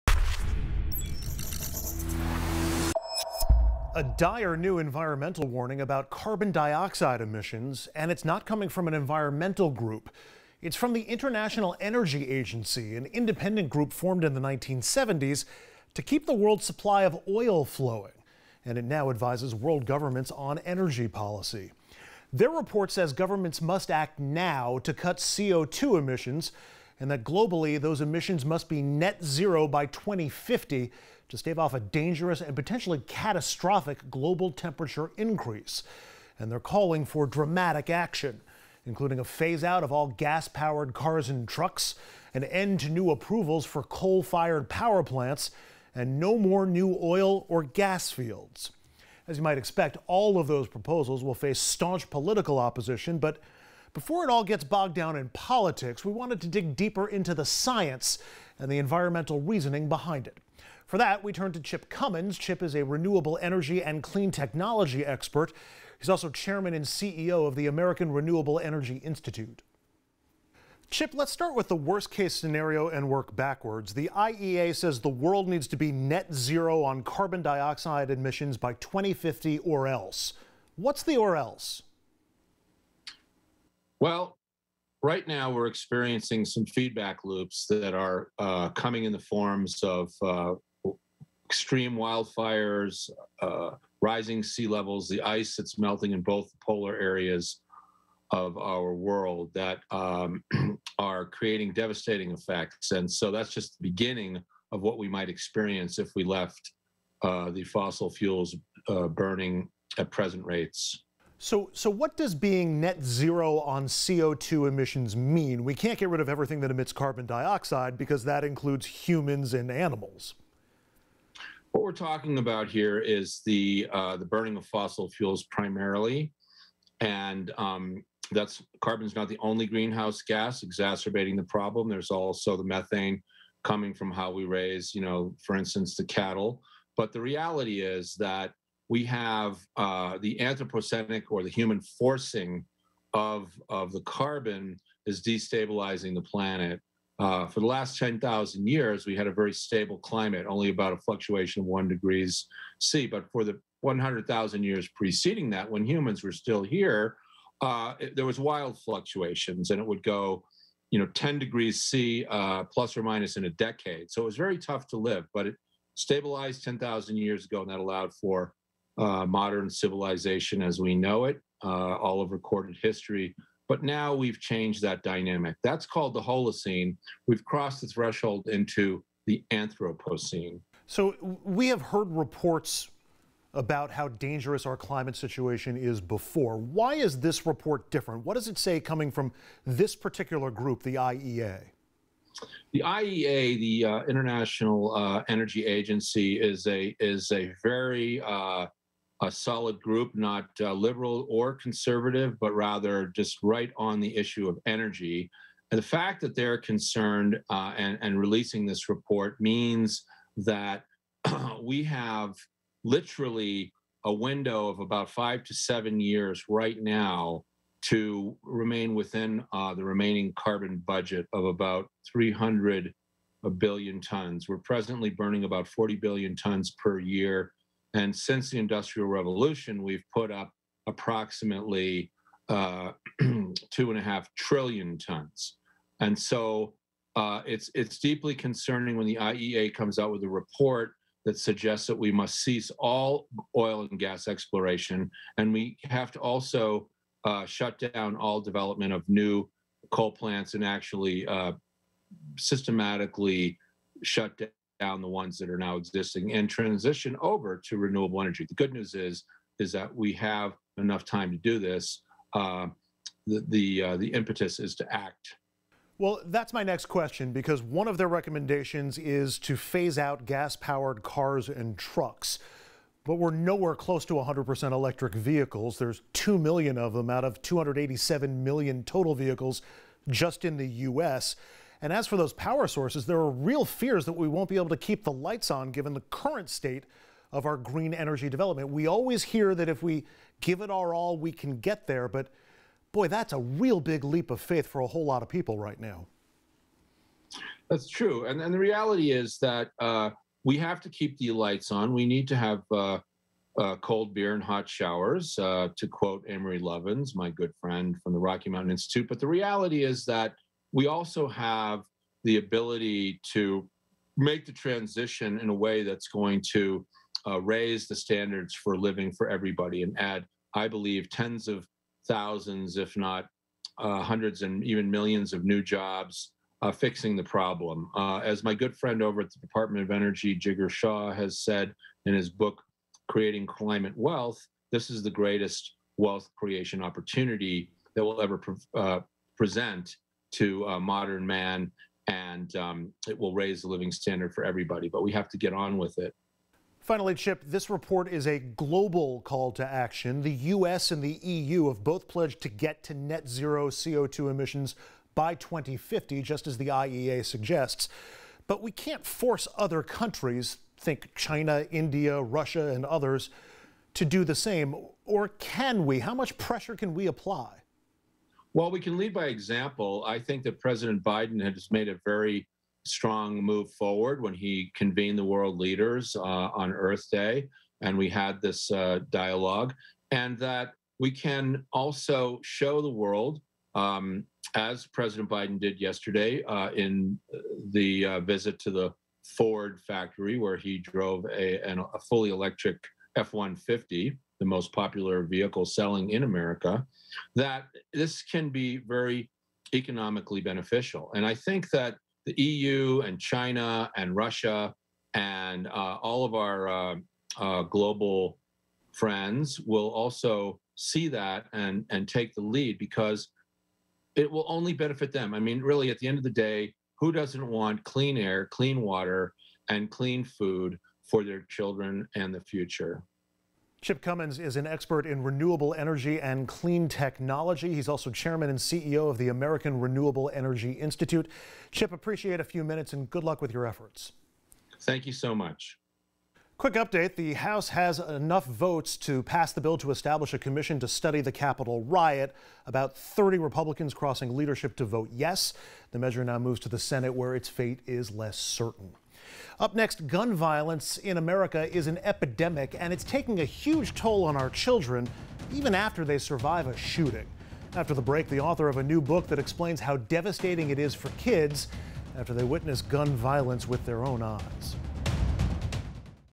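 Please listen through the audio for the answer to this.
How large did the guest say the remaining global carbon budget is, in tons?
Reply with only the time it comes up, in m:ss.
3:42.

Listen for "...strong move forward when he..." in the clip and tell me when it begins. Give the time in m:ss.
6:12.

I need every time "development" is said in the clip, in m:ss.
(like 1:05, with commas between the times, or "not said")
4:08, 4:48.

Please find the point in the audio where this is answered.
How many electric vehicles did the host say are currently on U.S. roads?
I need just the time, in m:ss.
4:36.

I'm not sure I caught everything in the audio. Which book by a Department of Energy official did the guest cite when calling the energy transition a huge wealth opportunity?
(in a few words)
Creating Climate Wealth.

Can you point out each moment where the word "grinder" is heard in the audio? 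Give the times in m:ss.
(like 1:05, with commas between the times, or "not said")
not said.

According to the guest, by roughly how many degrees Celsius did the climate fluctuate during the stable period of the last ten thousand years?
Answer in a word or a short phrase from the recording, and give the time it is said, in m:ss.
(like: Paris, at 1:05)
1 degree C, at 2:31.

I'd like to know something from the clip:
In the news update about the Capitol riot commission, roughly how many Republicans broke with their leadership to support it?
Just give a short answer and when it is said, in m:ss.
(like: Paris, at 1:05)
30, at 7:22.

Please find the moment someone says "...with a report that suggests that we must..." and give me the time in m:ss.
4:00.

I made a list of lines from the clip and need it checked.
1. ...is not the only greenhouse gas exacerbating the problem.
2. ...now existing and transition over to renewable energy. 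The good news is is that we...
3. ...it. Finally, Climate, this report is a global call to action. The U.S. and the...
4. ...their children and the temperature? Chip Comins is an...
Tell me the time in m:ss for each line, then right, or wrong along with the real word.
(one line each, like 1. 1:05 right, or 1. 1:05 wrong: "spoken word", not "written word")
1. 2:09 right
2. 4:15 right
3. 5:45 wrong: "Chip", not "Climate"
4. 7:01 wrong: "future", not "temperature".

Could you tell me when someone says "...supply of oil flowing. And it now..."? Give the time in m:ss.
0:16.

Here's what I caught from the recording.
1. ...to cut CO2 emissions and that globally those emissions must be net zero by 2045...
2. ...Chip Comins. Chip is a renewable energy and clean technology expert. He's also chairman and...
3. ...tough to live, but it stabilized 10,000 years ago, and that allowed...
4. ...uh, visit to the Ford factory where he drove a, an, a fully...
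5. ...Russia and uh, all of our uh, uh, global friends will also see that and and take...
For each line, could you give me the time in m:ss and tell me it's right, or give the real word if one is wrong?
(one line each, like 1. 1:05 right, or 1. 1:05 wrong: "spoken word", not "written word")
1. 0:24 wrong: "2050", not "2045"
2. 1:01 right
3. 2:44 right
4. 6:28 right
5. 6:44 right.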